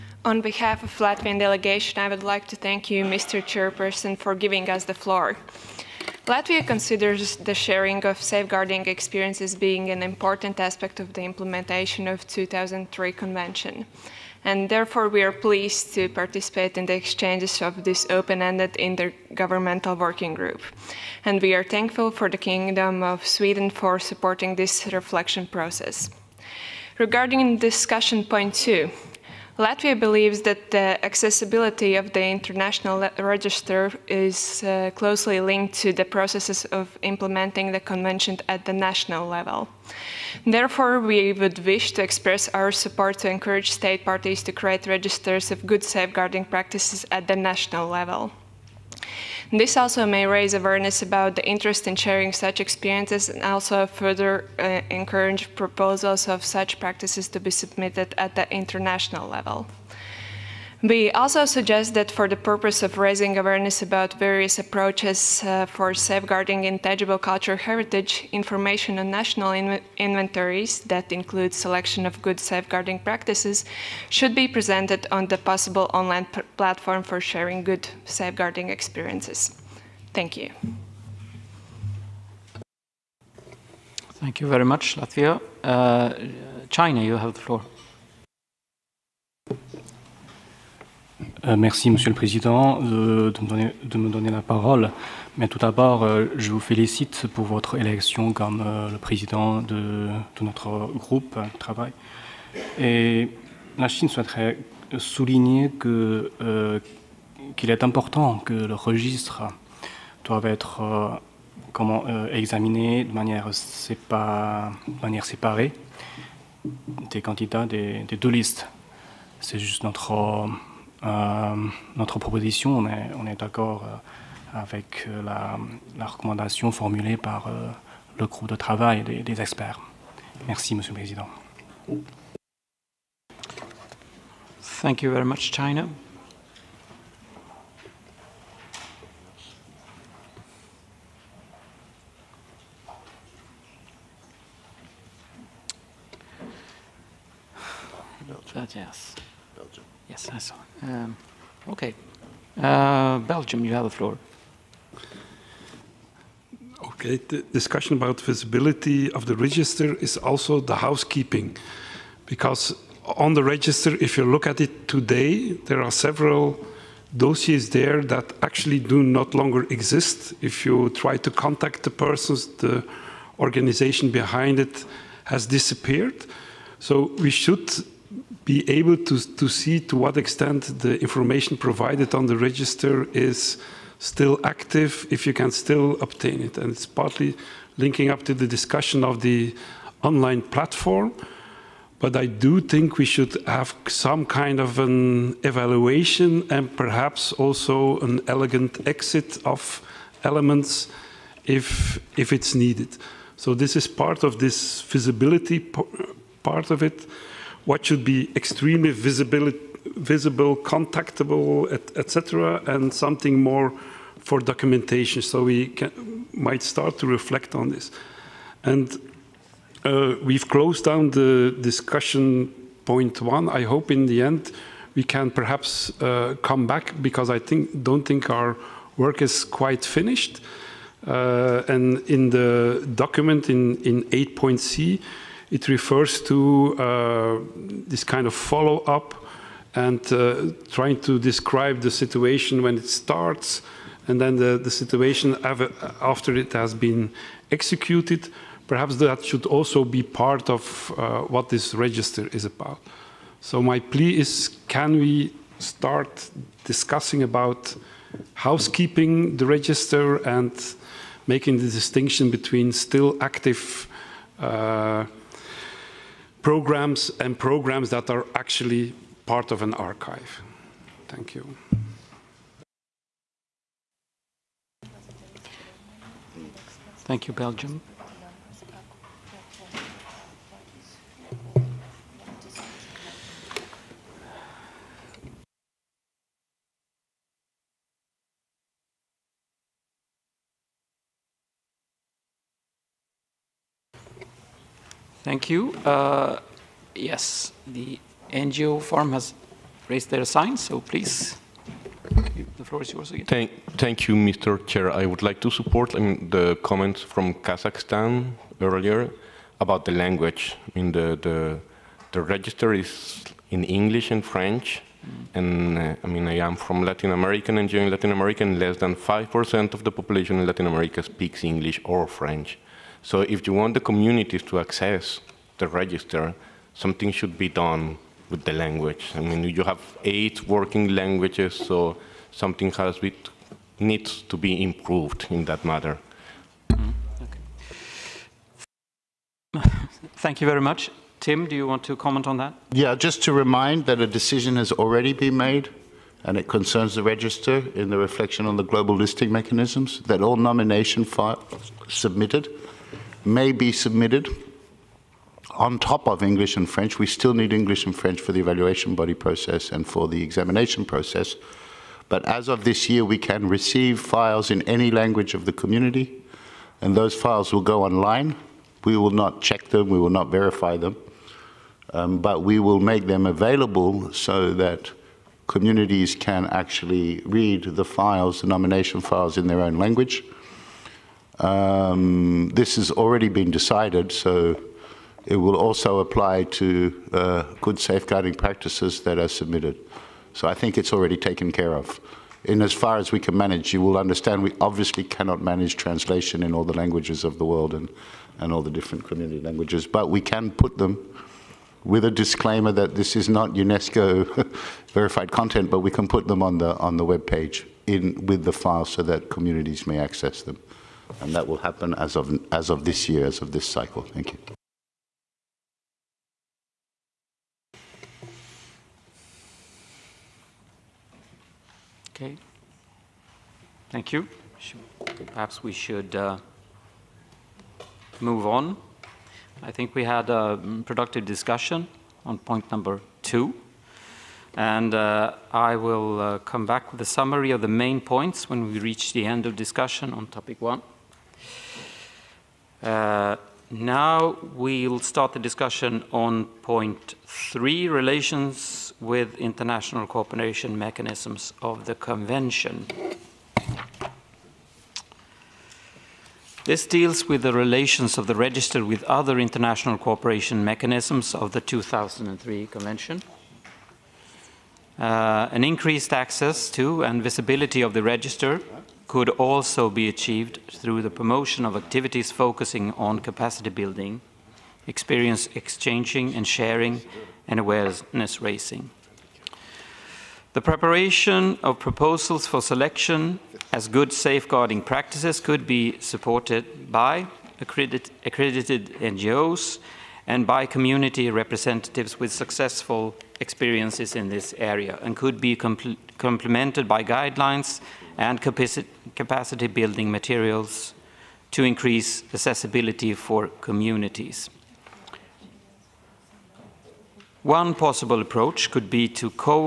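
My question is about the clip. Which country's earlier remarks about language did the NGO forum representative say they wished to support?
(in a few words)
Kazakhstan.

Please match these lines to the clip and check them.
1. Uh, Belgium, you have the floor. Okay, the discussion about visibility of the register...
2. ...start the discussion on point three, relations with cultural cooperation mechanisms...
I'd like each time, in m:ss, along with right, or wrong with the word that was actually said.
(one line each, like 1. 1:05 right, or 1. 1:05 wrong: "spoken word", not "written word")
1. 2:32 right
2. 7:24 wrong: "international", not "cultural".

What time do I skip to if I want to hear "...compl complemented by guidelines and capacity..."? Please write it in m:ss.
8:15.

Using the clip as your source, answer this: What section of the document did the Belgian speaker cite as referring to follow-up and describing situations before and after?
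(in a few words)
8.c.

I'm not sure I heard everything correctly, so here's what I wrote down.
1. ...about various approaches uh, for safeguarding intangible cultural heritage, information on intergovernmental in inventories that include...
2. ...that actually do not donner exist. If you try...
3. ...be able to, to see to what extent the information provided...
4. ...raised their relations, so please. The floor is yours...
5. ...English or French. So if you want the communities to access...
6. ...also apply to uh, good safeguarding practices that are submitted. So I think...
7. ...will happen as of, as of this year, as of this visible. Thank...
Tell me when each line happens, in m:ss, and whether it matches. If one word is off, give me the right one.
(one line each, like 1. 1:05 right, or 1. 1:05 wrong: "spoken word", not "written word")
1. 1:03 wrong: "national", not "intergovernmental"
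2. 2:48 wrong: "longer", not "donner"
3. 2:58 right
4. 4:59 wrong: "signs", not "relations"
5. 5:21 right
6. 6:25 right
7. 6:51 wrong: "cycle", not "visible".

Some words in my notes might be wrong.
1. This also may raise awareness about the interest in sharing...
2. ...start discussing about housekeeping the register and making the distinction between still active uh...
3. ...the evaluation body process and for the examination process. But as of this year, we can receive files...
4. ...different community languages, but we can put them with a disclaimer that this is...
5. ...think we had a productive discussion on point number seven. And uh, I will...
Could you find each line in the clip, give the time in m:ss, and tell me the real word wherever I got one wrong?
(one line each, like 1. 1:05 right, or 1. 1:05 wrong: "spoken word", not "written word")
1. 0:49 right
2. 4:15 right
3. 5:58 right
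4. 6:38 right
5. 7:09 wrong: "two", not "seven".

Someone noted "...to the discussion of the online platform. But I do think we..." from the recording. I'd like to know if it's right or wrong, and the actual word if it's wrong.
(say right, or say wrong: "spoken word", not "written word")
right.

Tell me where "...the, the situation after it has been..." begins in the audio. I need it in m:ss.
4:04.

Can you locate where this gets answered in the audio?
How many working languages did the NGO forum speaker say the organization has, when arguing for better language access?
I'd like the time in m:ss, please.
5:30.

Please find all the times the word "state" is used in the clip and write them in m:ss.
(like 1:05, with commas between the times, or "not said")
0:43.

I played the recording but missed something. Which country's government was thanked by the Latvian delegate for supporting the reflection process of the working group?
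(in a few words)
Sweden.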